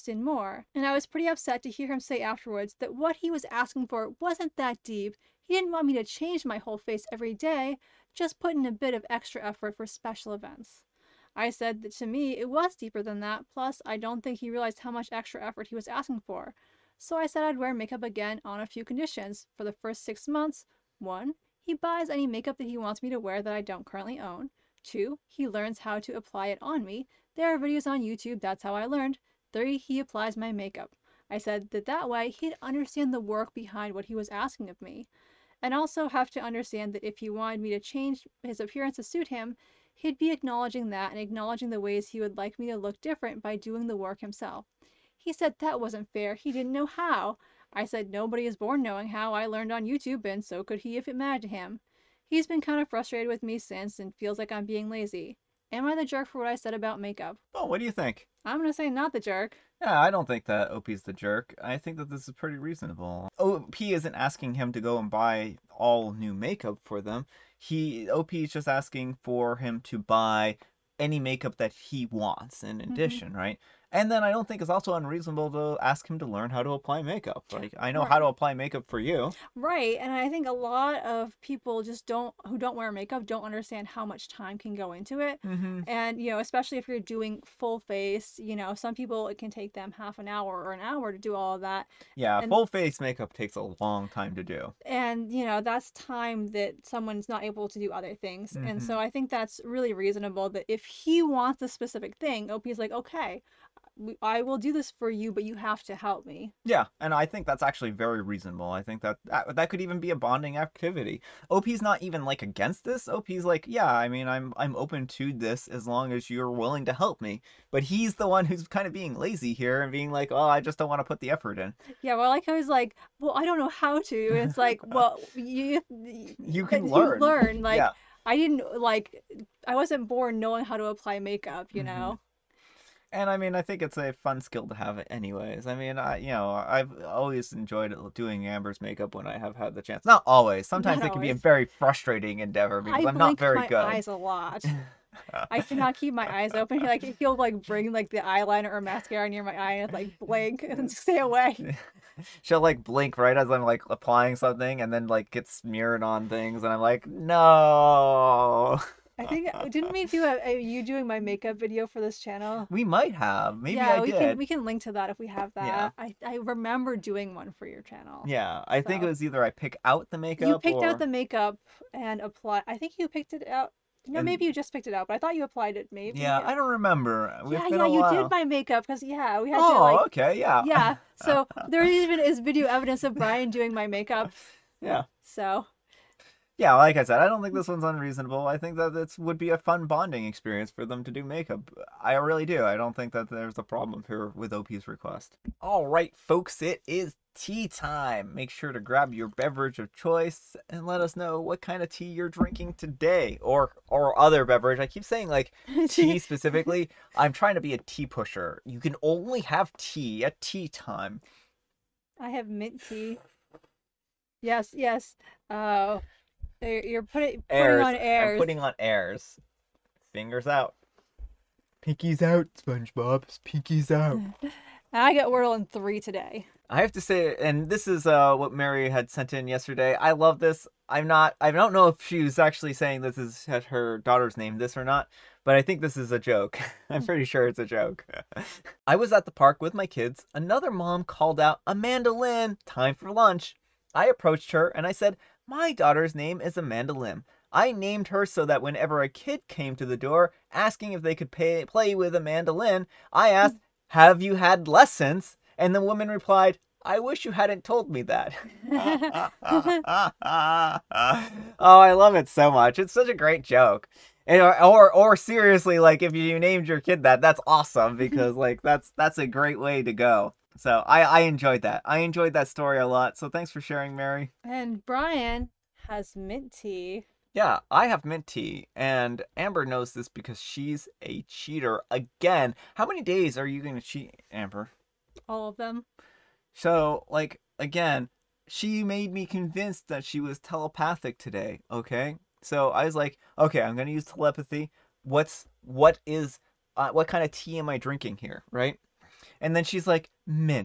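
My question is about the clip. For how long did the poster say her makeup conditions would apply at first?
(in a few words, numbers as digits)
six months.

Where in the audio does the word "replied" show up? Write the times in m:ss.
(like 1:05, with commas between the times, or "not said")
4:16.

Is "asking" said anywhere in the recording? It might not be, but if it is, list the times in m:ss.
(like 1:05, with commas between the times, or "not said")
0:03, 0:15, 0:34, 1:04, 1:08, 4:10.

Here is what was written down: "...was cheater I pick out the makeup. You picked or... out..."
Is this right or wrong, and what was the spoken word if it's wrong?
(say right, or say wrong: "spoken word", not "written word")
wrong: "either", not "cheater".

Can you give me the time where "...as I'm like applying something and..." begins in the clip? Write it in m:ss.
2:33.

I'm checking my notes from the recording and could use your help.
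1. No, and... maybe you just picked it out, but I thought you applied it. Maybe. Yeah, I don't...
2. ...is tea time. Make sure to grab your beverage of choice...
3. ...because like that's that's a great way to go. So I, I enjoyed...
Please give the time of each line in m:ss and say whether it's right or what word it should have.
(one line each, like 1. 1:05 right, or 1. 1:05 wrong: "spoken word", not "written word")
1. 2:54 right
2. 3:16 right
3. 4:27 right.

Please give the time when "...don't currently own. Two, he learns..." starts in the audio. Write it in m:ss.
0:23.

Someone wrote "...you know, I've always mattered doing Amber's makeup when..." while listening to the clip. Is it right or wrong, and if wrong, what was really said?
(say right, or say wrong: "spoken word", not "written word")
wrong: "enjoyed", not "mattered".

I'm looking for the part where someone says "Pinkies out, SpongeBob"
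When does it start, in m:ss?
3:41.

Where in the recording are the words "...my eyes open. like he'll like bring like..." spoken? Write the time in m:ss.
2:26.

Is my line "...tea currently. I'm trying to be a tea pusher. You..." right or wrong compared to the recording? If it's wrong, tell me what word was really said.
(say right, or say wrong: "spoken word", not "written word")
wrong: "specifically", not "currently".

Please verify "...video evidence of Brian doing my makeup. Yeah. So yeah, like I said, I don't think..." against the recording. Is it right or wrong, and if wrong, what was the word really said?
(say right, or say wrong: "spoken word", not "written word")
right.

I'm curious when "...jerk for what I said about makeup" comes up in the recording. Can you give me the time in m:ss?
0:56.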